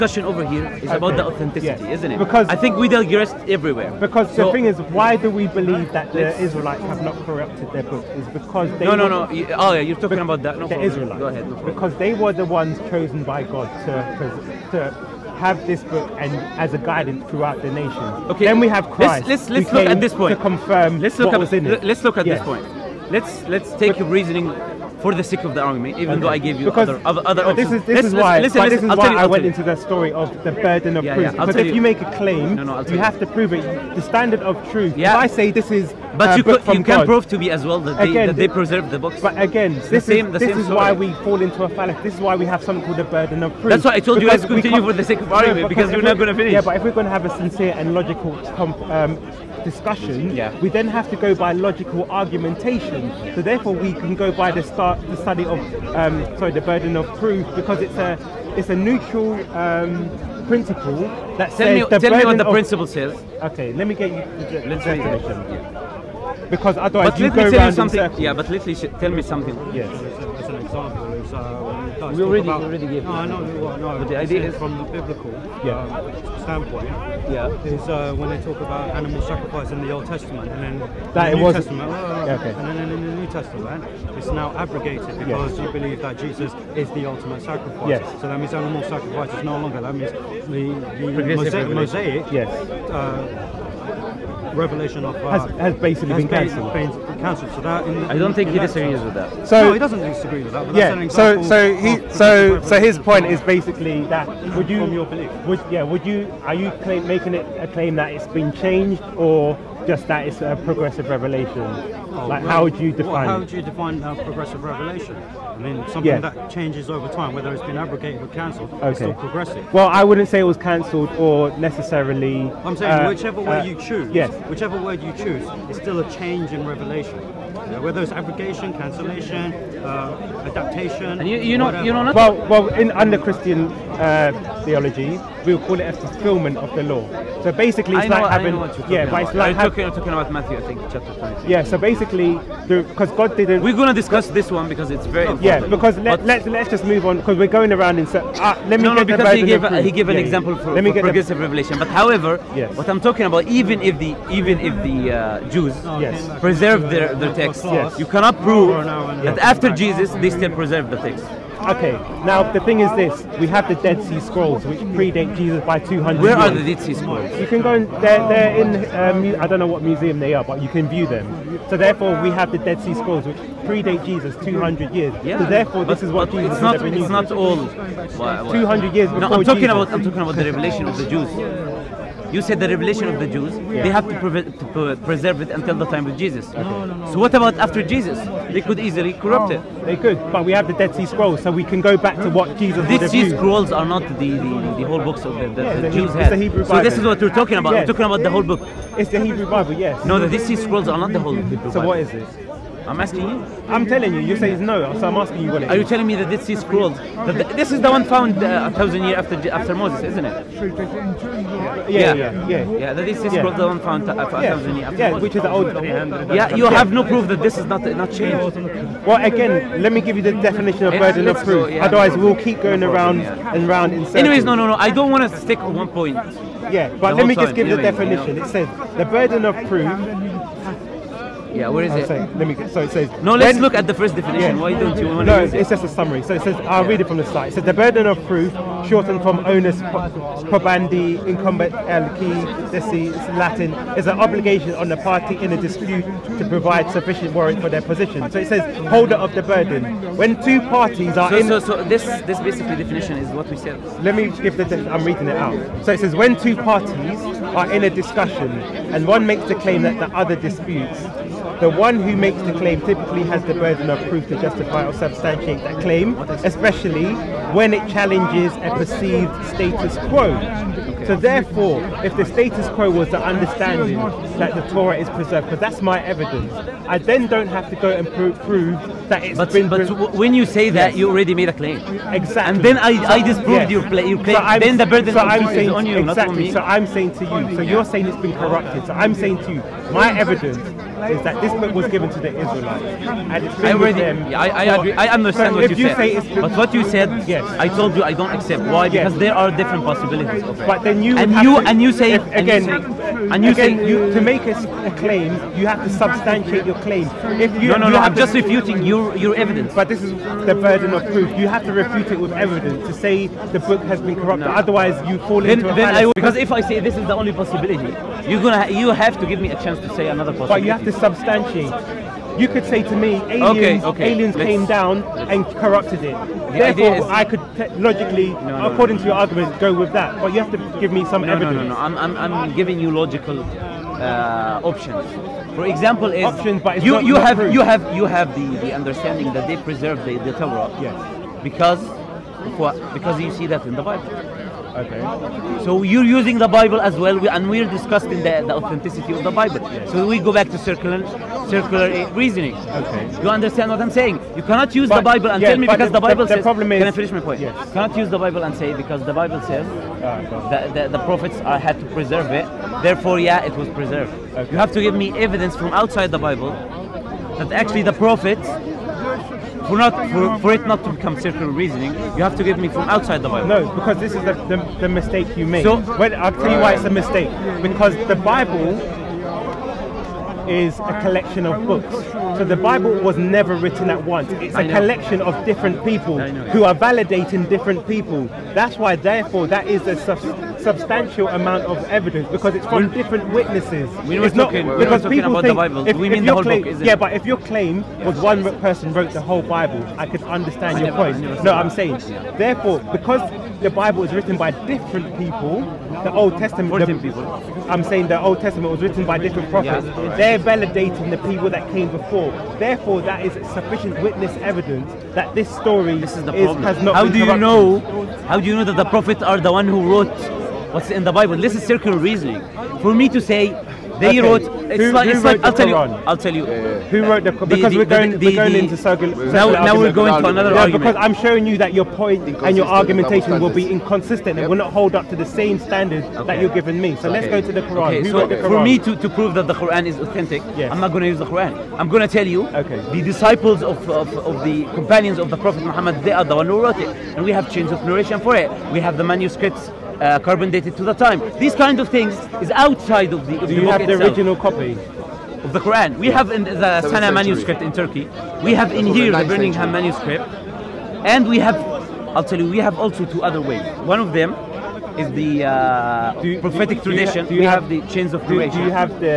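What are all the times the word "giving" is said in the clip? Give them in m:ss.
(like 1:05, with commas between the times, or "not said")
5:32, 7:16.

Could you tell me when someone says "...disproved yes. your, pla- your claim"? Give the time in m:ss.
4:43.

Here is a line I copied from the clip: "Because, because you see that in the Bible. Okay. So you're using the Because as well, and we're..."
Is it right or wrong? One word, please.
wrong.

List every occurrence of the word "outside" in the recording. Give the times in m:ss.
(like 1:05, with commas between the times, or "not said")
6:05, 6:12, 7:32.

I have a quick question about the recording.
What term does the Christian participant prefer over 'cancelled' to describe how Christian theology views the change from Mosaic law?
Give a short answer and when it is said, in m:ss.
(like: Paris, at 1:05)
fulfillment of the law, at 2:15.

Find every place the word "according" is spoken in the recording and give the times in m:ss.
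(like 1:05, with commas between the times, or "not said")
5:28.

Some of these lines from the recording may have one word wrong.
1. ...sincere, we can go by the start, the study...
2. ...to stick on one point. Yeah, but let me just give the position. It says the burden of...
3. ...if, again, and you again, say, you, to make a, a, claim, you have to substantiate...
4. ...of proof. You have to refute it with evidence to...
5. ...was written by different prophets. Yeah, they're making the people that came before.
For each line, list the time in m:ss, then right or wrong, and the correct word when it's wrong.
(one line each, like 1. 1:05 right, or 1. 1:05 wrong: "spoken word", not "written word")
1. 0:53 wrong: "therefore", not "sincere"
2. 3:45 wrong: "definition", not "position"
3. 5:02 right
4. 5:10 right
5. 6:48 wrong: "validating", not "making".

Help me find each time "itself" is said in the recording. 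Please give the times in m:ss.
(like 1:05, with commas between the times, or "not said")
7:33.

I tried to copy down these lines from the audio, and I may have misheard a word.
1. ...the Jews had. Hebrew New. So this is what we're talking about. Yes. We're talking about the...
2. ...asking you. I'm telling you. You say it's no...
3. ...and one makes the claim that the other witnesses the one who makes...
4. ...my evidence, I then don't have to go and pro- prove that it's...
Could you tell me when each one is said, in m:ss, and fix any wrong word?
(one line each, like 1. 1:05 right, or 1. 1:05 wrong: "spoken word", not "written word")
1. 3:15 wrong: "Bible", not "New"
2. 3:22 right
3. 4:18 wrong: "disputes", not "witnesses"
4. 4:35 right.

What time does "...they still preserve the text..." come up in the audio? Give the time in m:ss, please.
2:40.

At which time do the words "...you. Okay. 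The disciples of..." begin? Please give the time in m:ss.
7:22.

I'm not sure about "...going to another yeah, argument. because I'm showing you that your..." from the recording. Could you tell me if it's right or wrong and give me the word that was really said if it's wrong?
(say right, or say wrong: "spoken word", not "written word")
right.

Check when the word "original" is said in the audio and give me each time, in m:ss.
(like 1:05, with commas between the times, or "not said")
7:34.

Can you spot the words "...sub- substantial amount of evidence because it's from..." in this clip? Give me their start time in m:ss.
6:29.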